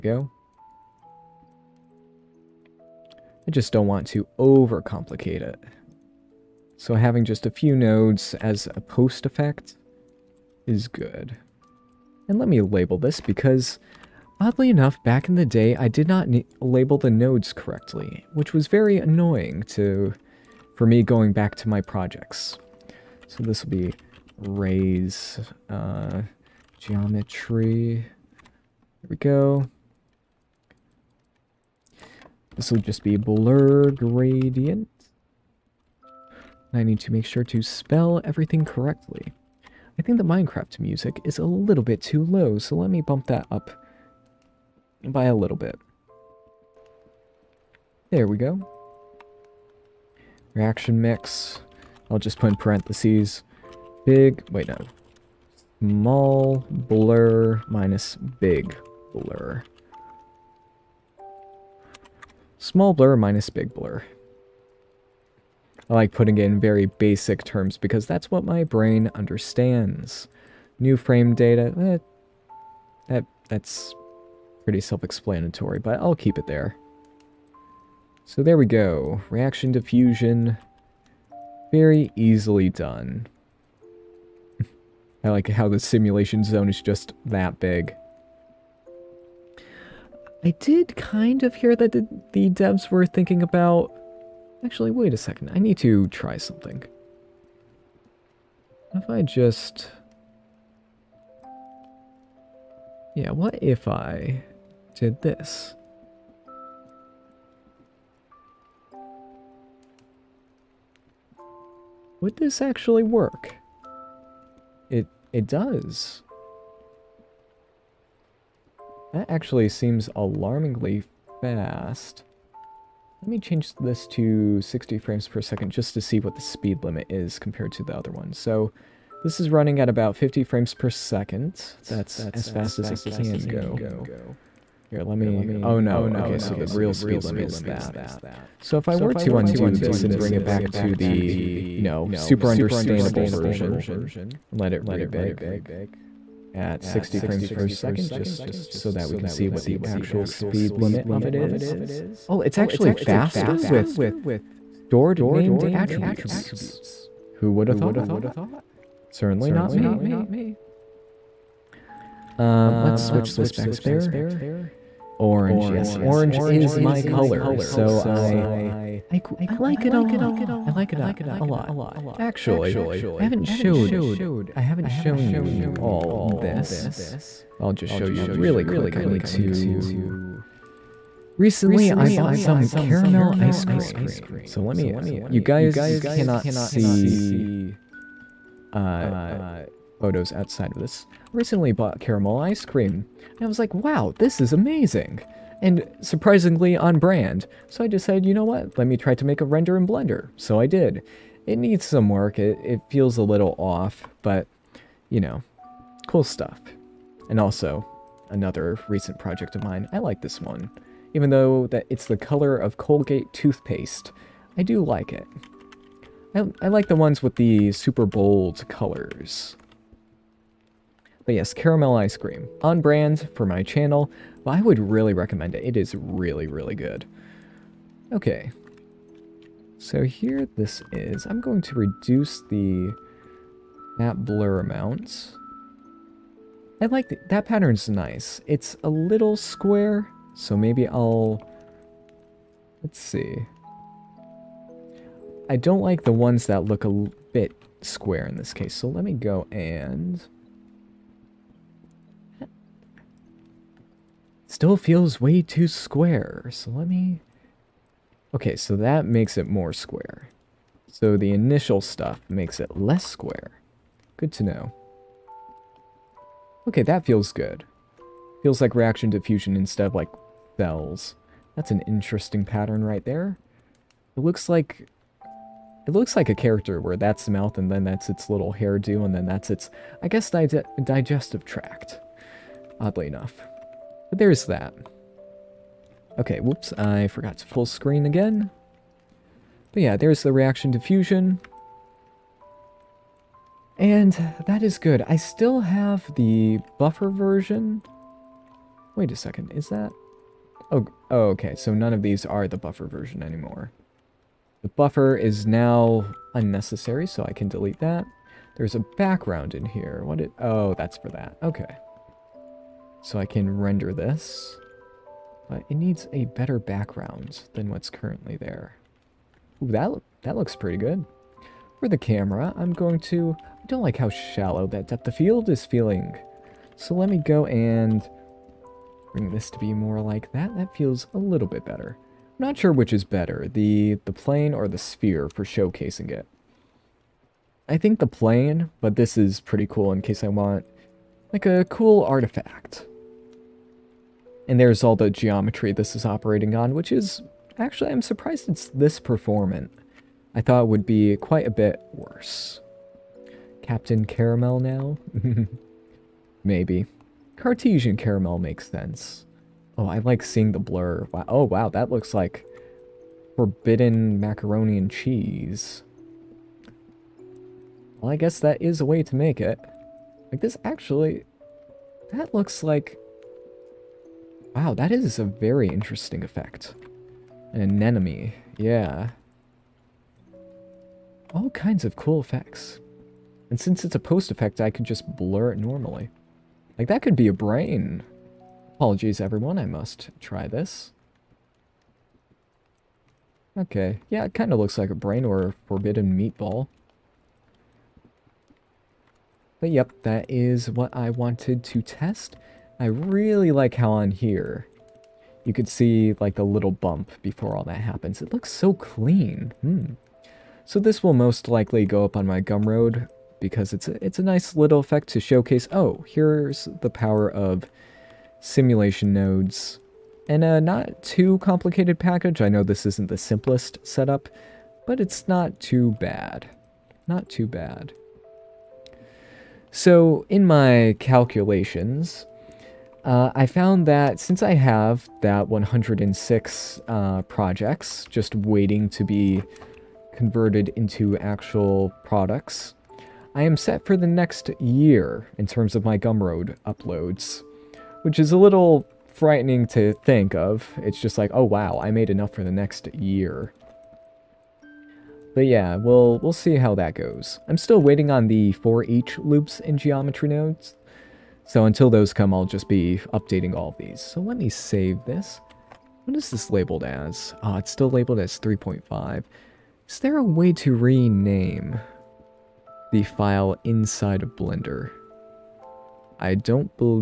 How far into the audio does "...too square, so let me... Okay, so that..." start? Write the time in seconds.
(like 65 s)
255 s.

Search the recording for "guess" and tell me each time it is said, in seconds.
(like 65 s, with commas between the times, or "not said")
280 s, 368 s.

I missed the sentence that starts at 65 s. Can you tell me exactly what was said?
I like putting it in very basic terms because that's what my brain understands.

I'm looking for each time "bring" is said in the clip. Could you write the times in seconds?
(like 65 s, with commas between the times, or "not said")
140 s, 329 s.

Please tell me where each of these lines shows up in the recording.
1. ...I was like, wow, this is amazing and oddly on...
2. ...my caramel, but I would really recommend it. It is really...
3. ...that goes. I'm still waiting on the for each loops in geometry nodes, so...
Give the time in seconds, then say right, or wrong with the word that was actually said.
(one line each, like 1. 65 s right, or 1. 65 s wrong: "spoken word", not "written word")
1. 193 s wrong: "surprisingly", not "oddly"
2. 223 s wrong: "channel", not "caramel"
3. 456 s right.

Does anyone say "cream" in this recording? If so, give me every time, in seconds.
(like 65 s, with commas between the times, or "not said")
183 s, 192 s, 222 s.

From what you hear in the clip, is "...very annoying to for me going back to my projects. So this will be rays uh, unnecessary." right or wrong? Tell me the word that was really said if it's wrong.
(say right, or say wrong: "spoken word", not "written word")
wrong: "geometry", not "unnecessary".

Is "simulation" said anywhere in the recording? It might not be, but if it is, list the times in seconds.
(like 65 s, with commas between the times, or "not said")
85 s, 418 s.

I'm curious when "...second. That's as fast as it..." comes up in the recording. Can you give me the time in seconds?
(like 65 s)
130 s.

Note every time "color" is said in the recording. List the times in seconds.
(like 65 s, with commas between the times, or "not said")
167 s, 212 s, 218 s.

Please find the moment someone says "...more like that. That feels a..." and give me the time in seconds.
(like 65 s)
329 s.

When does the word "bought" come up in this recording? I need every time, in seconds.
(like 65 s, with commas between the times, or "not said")
182 s, 191 s.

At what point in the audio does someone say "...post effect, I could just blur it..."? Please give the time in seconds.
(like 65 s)
383 s.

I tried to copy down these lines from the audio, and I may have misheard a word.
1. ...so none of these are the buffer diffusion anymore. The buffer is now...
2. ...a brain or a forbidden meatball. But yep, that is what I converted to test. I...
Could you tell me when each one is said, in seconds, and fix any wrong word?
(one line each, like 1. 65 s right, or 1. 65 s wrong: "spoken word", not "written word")
1. 301 s wrong: "version", not "diffusion"
2. 394 s wrong: "wanted", not "converted".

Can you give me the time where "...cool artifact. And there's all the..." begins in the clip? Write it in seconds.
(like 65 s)
341 s.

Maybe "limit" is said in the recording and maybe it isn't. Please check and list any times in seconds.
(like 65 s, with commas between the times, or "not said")
126 s, 137 s, 150 s.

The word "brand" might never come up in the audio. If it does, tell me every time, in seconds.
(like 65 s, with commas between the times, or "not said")
196 s, 222 s.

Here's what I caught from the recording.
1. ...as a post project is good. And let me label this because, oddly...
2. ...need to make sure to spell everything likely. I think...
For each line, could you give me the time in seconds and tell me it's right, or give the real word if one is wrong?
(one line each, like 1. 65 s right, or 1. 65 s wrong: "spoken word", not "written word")
1. 8 s wrong: "effect", not "project"
2. 36 s wrong: "correctly", not "likely".